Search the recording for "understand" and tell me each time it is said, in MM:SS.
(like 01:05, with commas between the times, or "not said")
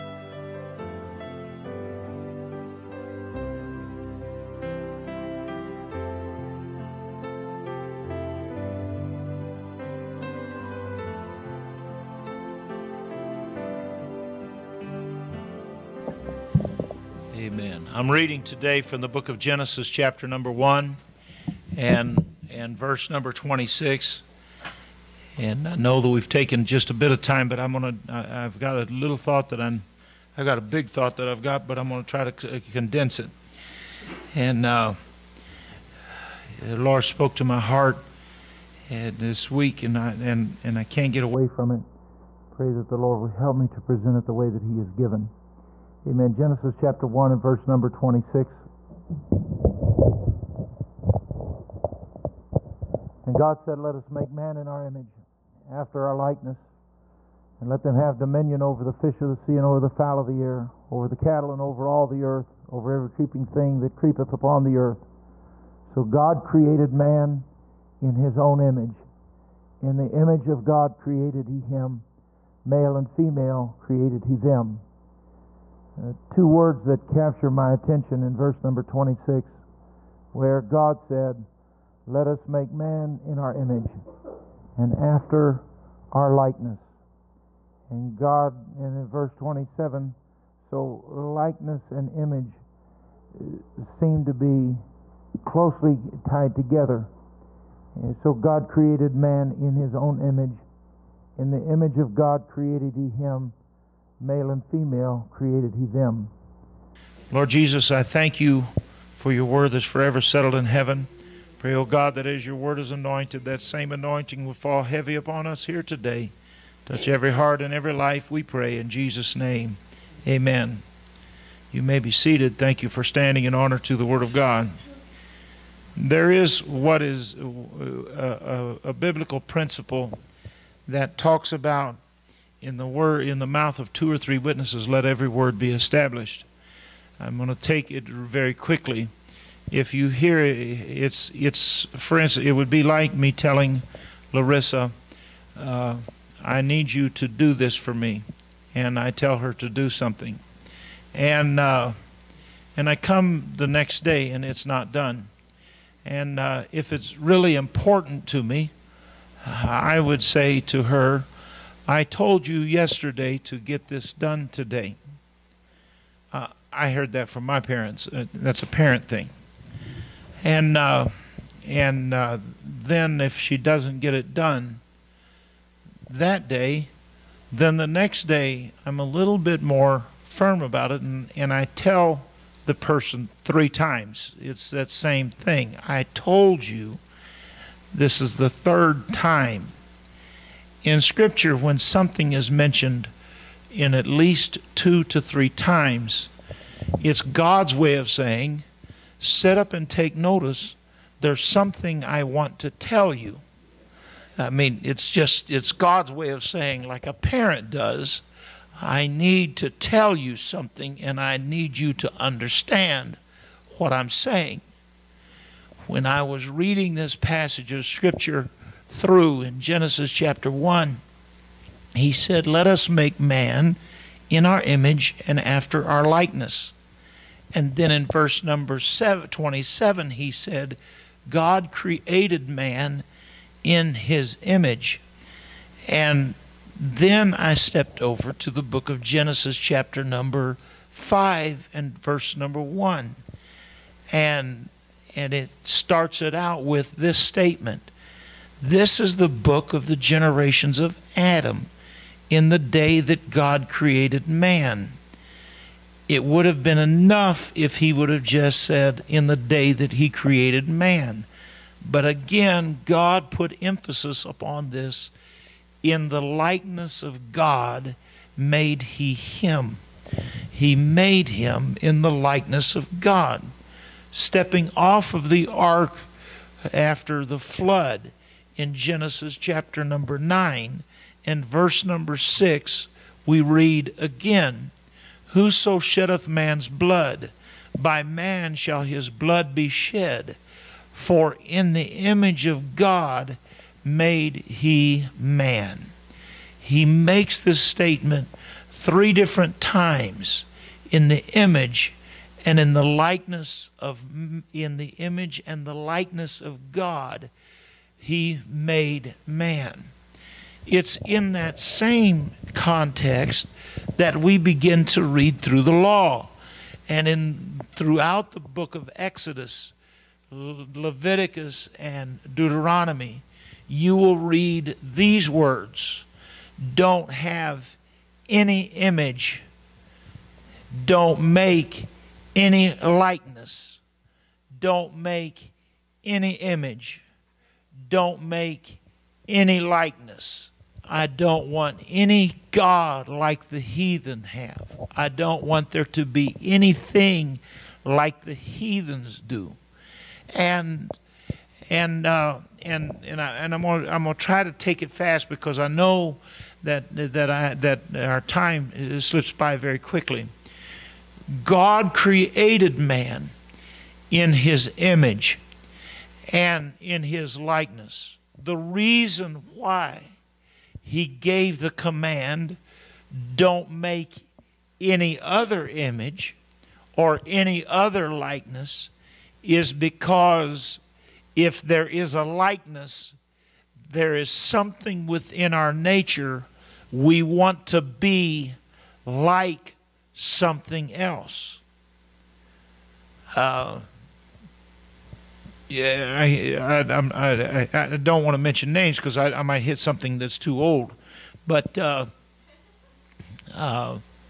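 03:32.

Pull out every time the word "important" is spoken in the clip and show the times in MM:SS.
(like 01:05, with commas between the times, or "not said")
02:37.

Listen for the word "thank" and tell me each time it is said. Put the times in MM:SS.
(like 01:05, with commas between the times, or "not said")
01:48, 02:02.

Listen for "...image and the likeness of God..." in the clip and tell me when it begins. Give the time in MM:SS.
05:04.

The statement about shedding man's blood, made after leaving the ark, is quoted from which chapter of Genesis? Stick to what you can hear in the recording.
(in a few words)
Chapter 9.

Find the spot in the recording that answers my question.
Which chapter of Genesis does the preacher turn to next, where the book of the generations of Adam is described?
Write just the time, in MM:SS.
03:59.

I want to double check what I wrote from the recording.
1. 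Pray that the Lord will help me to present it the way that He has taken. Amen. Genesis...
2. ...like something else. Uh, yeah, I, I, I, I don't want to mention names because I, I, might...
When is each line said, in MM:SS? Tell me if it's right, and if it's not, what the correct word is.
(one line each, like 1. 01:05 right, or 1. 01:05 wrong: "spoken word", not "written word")
1. 00:42 wrong: "given", not "taken"
2. 06:29 right.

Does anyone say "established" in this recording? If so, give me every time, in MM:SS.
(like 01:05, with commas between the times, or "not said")
02:15.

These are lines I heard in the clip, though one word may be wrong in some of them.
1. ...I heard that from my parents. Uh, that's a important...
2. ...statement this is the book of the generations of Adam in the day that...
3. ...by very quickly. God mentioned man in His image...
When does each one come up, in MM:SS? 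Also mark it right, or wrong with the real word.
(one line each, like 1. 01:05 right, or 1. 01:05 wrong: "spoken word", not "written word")
1. 02:46 wrong: "parent", not "important"
2. 04:07 right
3. 05:59 wrong: "created", not "mentioned".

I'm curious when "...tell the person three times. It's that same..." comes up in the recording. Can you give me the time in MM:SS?
03:01.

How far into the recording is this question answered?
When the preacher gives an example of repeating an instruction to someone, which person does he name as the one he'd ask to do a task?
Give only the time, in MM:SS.
02:24.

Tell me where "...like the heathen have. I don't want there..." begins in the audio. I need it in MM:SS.
05:43.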